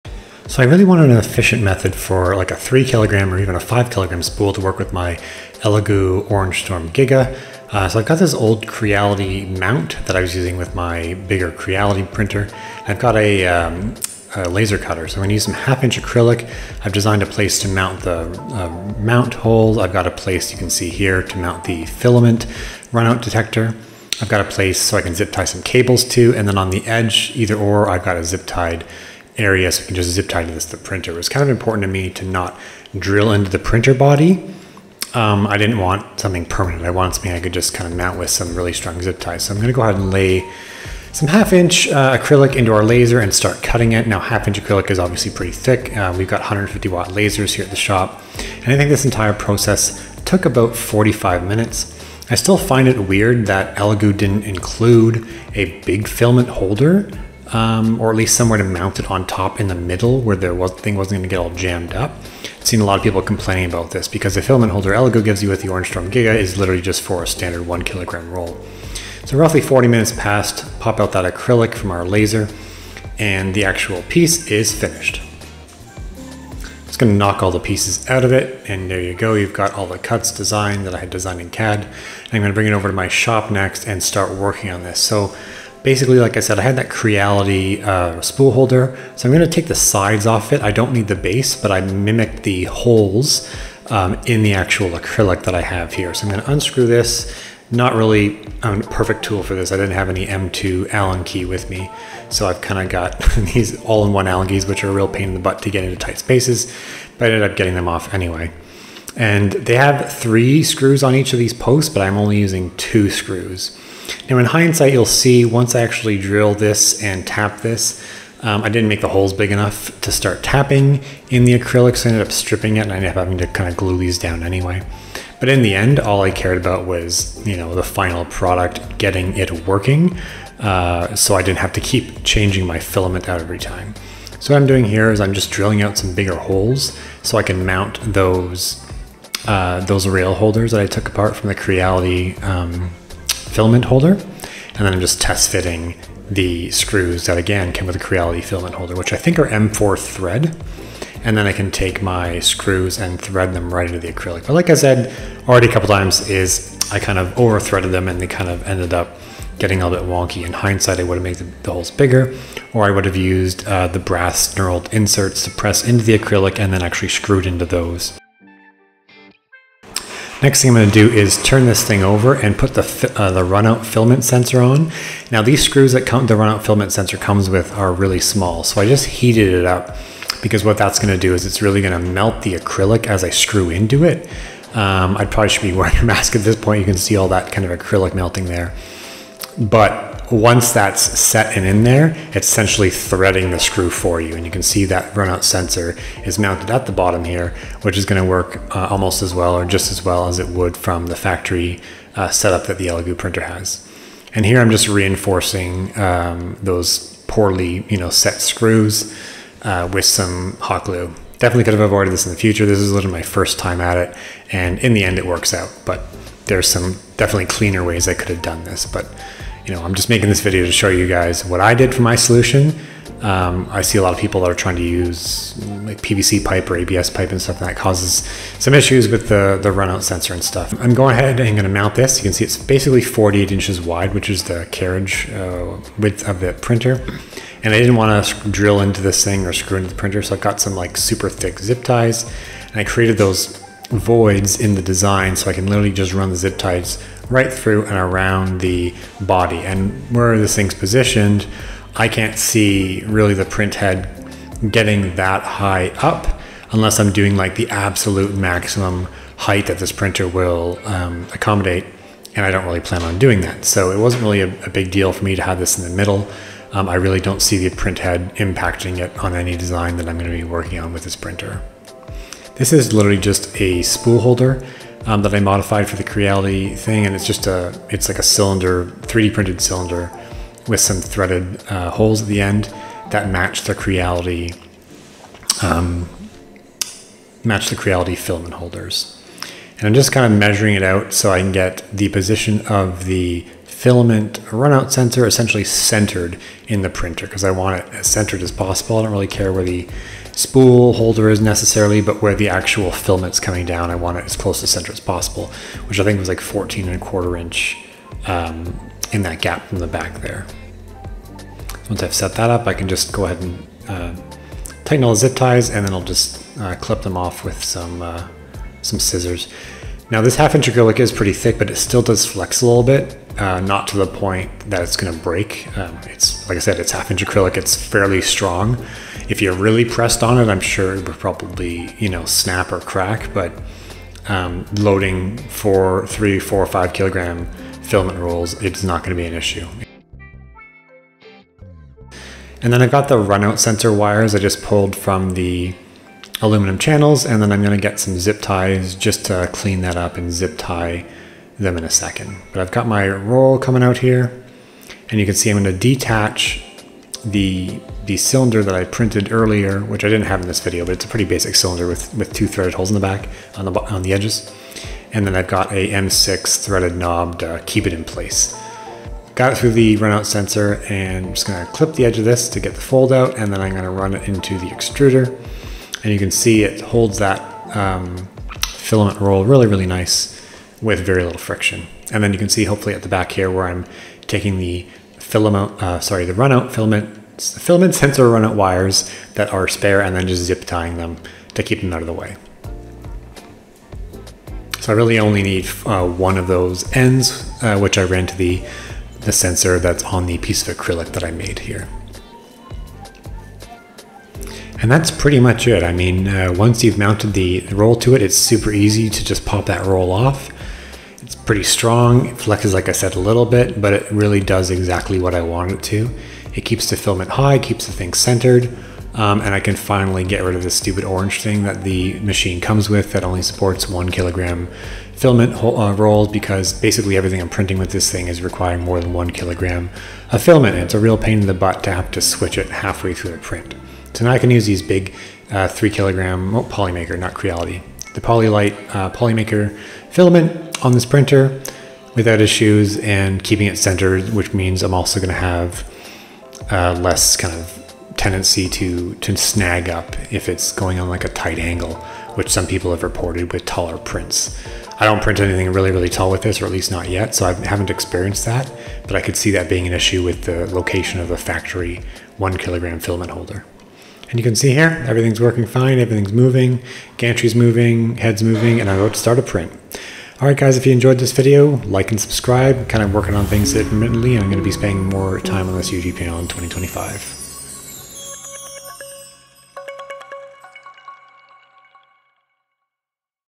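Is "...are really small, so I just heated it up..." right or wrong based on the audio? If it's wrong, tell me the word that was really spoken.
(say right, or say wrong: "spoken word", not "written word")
right.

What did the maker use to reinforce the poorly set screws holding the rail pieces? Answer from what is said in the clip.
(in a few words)
hot glue.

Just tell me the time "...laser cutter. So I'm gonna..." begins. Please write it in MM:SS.
00:14.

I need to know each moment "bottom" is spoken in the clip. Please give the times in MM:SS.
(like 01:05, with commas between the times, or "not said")
03:16.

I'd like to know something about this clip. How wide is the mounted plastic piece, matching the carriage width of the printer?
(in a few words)
48 inches.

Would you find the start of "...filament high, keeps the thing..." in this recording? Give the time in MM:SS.
06:56.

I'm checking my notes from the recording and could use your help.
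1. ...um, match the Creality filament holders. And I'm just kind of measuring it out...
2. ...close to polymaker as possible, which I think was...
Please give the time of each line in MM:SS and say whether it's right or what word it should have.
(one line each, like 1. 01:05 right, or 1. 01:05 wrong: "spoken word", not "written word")
1. 04:45 right
2. 05:04 wrong: "center", not "polymaker".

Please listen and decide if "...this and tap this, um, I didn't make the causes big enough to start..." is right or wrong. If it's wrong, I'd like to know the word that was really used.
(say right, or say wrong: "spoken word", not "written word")
wrong: "holes", not "causes".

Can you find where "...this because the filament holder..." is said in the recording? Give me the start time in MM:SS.
01:03.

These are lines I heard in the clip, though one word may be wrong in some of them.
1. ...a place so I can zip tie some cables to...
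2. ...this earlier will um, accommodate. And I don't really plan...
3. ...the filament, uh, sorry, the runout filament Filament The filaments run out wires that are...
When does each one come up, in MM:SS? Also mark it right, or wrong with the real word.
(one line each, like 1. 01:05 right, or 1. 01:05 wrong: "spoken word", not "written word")
1. 00:24 right
2. 04:19 wrong: "printer", not "earlier"
3. 06:24 right.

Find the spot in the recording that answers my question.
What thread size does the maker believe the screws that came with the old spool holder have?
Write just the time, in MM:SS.
02:29.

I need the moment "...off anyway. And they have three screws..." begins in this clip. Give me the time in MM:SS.
01:47.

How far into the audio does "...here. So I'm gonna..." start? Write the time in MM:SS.
01:35.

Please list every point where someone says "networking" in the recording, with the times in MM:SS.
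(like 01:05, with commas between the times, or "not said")
not said.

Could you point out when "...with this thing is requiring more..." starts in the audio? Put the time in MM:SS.
07:07.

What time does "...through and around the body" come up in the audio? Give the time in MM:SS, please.
04:07.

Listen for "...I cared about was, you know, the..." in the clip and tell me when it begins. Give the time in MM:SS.
02:06.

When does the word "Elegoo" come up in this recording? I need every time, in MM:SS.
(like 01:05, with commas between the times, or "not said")
00:05, 00:53, 01:04, 03:22.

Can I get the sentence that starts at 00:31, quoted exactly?
It was kind of important to me to not drill into the printer body.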